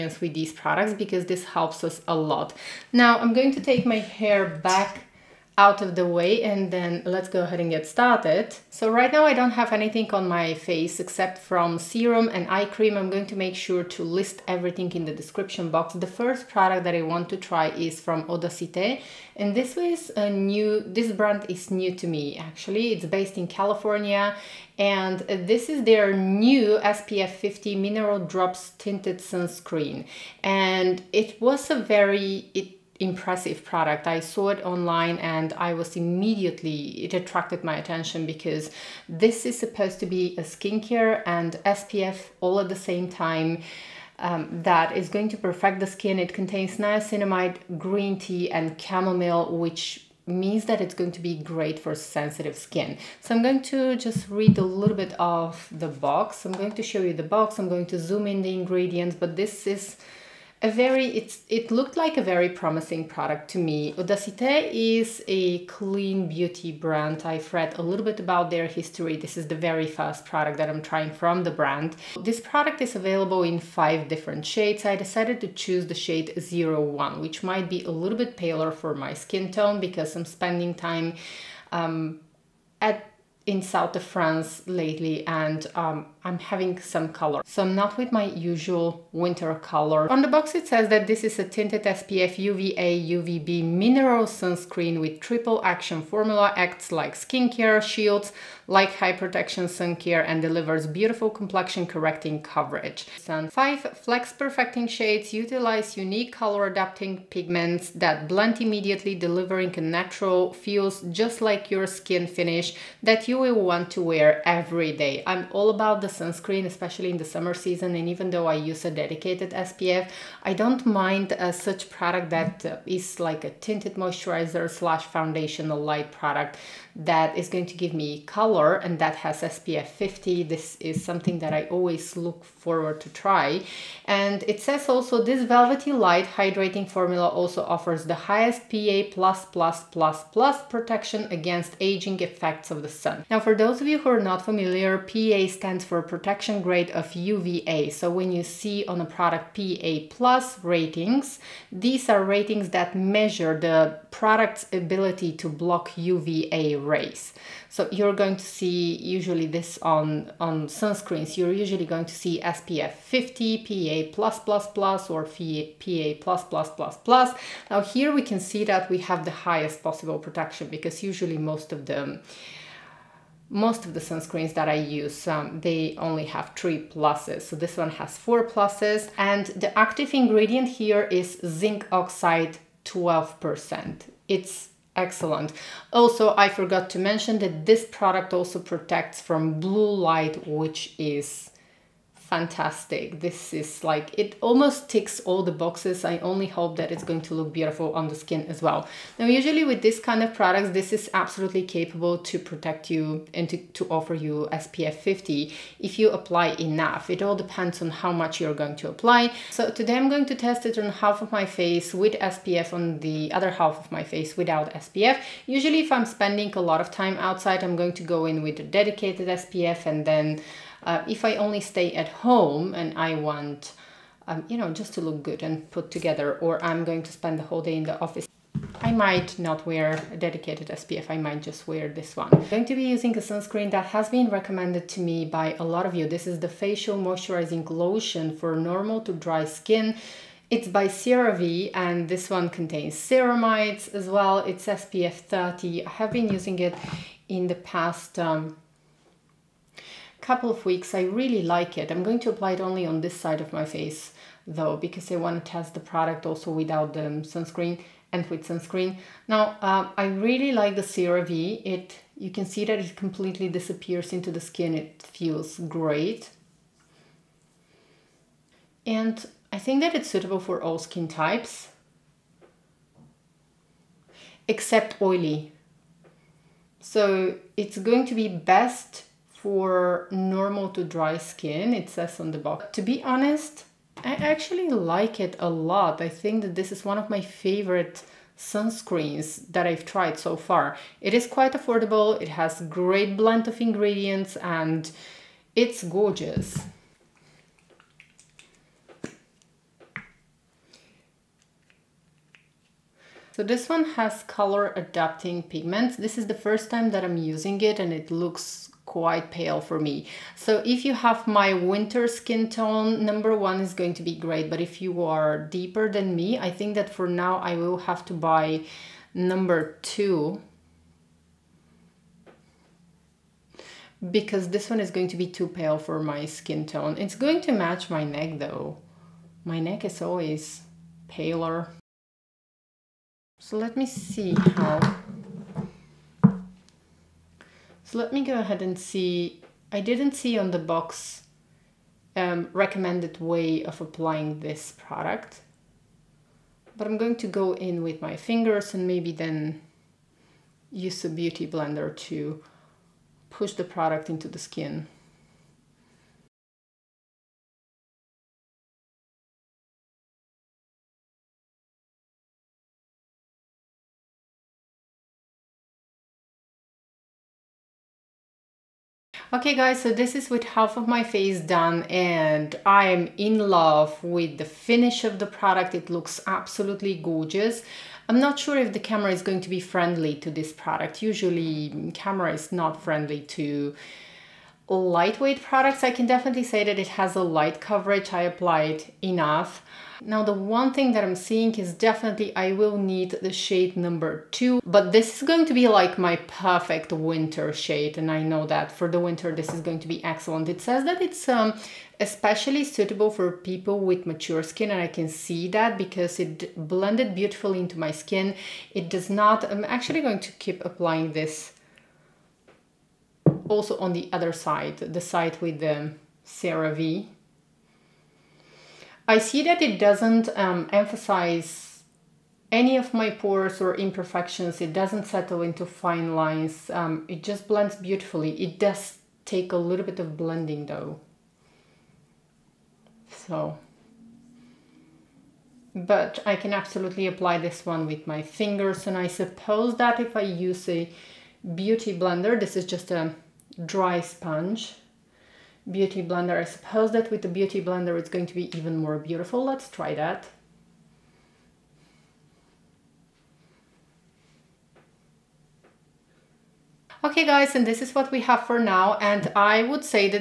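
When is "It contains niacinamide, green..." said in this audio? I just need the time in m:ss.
0:46.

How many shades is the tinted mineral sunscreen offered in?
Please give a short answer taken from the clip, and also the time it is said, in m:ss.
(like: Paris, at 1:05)
5, at 1:13.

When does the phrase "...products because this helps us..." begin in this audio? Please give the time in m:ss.
0:00.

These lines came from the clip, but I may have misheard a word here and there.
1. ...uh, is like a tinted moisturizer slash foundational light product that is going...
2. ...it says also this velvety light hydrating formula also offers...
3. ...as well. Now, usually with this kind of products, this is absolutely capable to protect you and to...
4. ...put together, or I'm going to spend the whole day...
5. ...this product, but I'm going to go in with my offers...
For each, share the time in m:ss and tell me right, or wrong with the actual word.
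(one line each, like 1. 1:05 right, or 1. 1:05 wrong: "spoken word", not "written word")
1. 2:02 right
2. 2:14 right
3. 3:18 right
4. 3:45 right
5. 5:44 wrong: "fingers", not "offers".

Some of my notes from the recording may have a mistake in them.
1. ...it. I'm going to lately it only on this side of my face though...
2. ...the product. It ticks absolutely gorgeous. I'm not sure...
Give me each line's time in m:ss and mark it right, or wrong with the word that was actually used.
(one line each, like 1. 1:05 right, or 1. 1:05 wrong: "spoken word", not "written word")
1. 4:11 wrong: "apply", not "lately"
2. 6:15 wrong: "looks", not "ticks".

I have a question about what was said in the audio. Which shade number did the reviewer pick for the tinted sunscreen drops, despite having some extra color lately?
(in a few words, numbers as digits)
01.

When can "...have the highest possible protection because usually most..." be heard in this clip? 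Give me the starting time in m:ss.
2:48.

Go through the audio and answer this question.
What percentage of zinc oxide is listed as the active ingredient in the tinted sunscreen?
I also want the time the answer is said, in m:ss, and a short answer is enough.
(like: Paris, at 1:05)
12%, at 3:02.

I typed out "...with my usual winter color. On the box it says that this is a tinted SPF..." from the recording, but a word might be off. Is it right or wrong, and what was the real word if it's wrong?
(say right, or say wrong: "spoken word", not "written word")
right.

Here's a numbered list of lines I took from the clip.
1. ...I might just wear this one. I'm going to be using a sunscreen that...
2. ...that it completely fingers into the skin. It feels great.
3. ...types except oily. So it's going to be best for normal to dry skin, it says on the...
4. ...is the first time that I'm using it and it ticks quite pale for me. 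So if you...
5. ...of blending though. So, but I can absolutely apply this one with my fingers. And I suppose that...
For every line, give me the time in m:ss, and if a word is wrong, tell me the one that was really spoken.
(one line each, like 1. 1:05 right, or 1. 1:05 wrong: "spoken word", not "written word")
1. 3:51 right
2. 4:22 wrong: "disappears", not "fingers"
3. 4:31 right
4. 5:06 wrong: "looks", not "ticks"
5. 7:09 right.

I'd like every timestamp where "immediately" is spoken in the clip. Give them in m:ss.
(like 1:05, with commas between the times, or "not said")
0:35, 1:48.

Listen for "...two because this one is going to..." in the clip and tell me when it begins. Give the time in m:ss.
5:19.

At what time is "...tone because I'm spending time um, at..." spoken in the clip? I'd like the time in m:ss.
1:19.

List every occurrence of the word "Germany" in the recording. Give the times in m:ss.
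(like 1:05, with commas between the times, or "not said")
not said.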